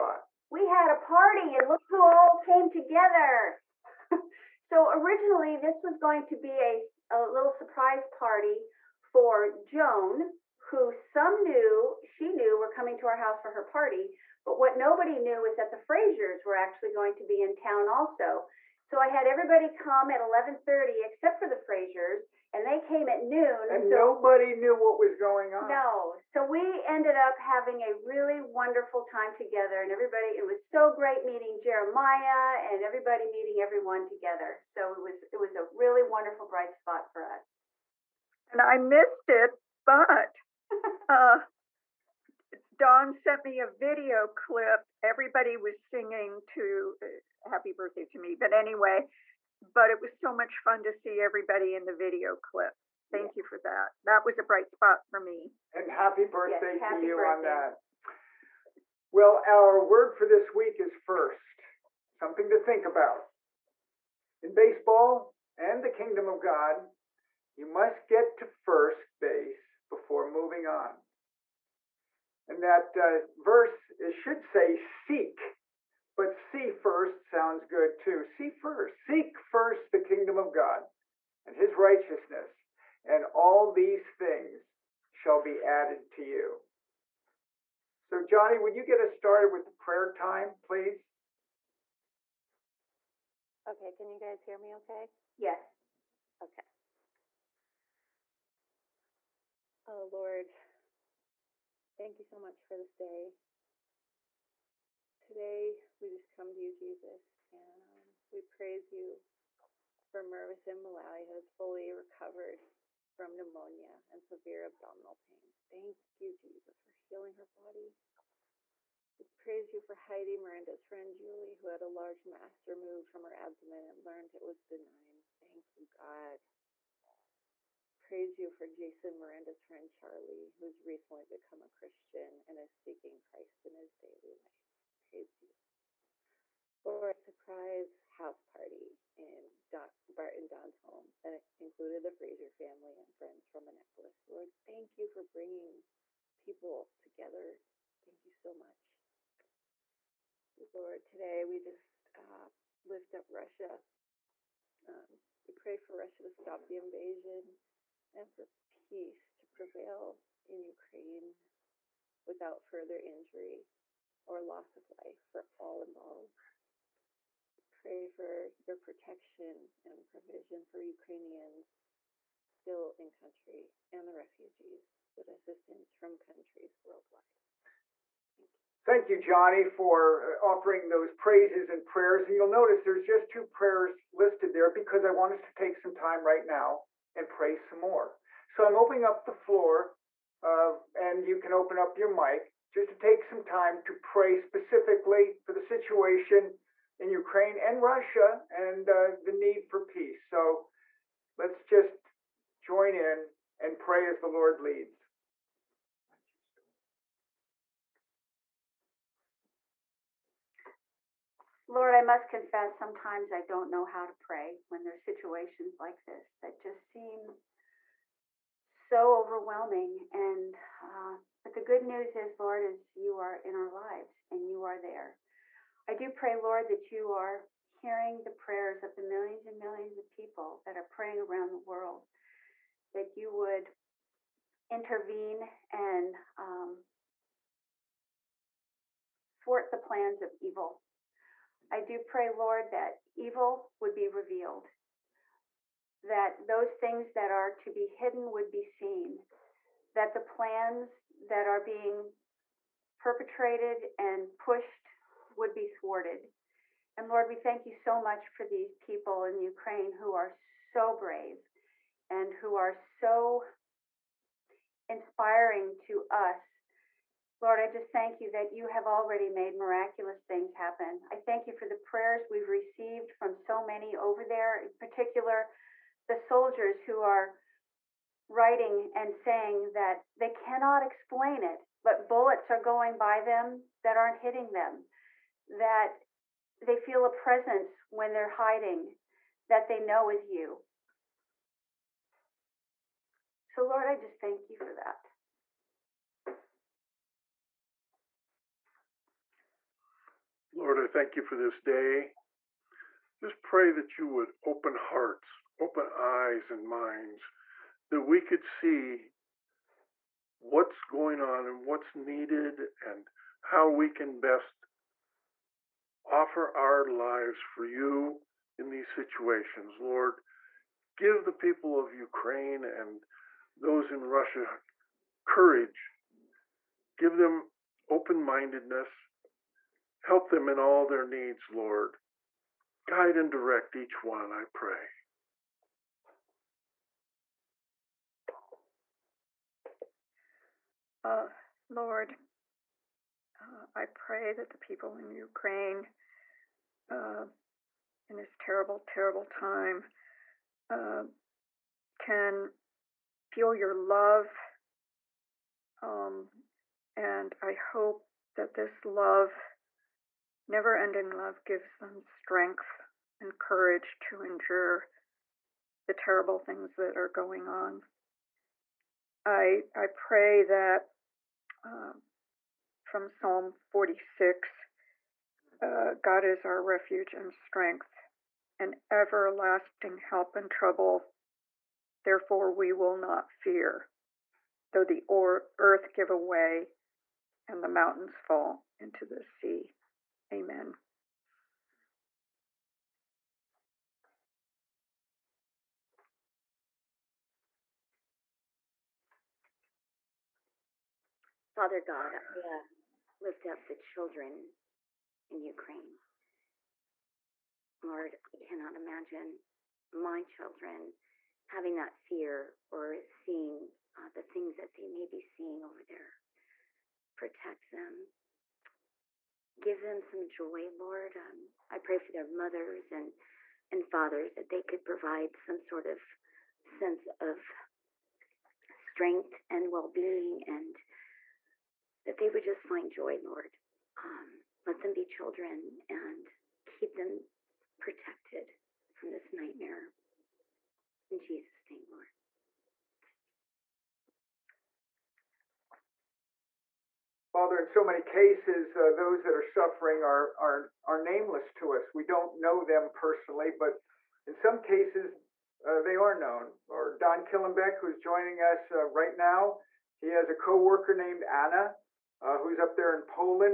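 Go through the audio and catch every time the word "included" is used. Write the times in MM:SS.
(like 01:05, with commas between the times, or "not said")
02:21.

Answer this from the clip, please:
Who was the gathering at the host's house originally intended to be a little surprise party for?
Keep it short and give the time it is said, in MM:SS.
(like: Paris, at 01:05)
Joan, at 00:09.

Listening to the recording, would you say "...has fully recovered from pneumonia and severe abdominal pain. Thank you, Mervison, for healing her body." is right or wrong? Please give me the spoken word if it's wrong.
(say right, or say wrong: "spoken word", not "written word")
wrong: "Jesus", not "Mervison".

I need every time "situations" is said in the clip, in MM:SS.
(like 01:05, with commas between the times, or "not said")
03:15, 03:35, 05:18.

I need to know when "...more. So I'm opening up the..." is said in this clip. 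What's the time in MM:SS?
03:07.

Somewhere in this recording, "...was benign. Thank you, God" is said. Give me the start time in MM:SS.
02:04.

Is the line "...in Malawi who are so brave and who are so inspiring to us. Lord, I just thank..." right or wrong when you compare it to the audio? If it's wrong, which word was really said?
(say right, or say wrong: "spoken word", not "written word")
wrong: "Ukraine", not "Malawi".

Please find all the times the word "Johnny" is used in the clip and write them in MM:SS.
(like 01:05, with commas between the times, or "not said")
01:28, 02:59.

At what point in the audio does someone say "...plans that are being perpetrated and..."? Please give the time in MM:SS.
04:10.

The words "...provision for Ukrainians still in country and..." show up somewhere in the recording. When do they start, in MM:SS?
02:50.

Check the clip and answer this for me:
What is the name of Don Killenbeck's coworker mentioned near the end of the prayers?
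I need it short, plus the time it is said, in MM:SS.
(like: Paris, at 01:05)
Anna, at 07:41.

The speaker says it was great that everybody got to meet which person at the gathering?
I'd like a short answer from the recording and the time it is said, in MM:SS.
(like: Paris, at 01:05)
Jeremiah, at 00:31.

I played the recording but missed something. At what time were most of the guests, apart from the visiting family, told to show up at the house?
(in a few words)
11:30.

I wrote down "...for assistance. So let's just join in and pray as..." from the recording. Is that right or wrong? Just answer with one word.
wrong.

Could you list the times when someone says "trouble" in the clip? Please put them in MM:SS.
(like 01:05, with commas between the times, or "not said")
06:20.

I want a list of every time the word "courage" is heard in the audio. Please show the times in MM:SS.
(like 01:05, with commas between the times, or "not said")
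05:25, 06:03.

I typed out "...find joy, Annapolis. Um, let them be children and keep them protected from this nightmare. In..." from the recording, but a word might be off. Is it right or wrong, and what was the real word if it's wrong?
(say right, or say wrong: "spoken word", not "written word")
wrong: "Lord", not "Annapolis".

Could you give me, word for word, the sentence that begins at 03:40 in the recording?
And uh, but the good news is, Lord, is you are in our lives and you are there.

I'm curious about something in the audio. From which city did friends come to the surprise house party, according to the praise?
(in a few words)
Annapolis.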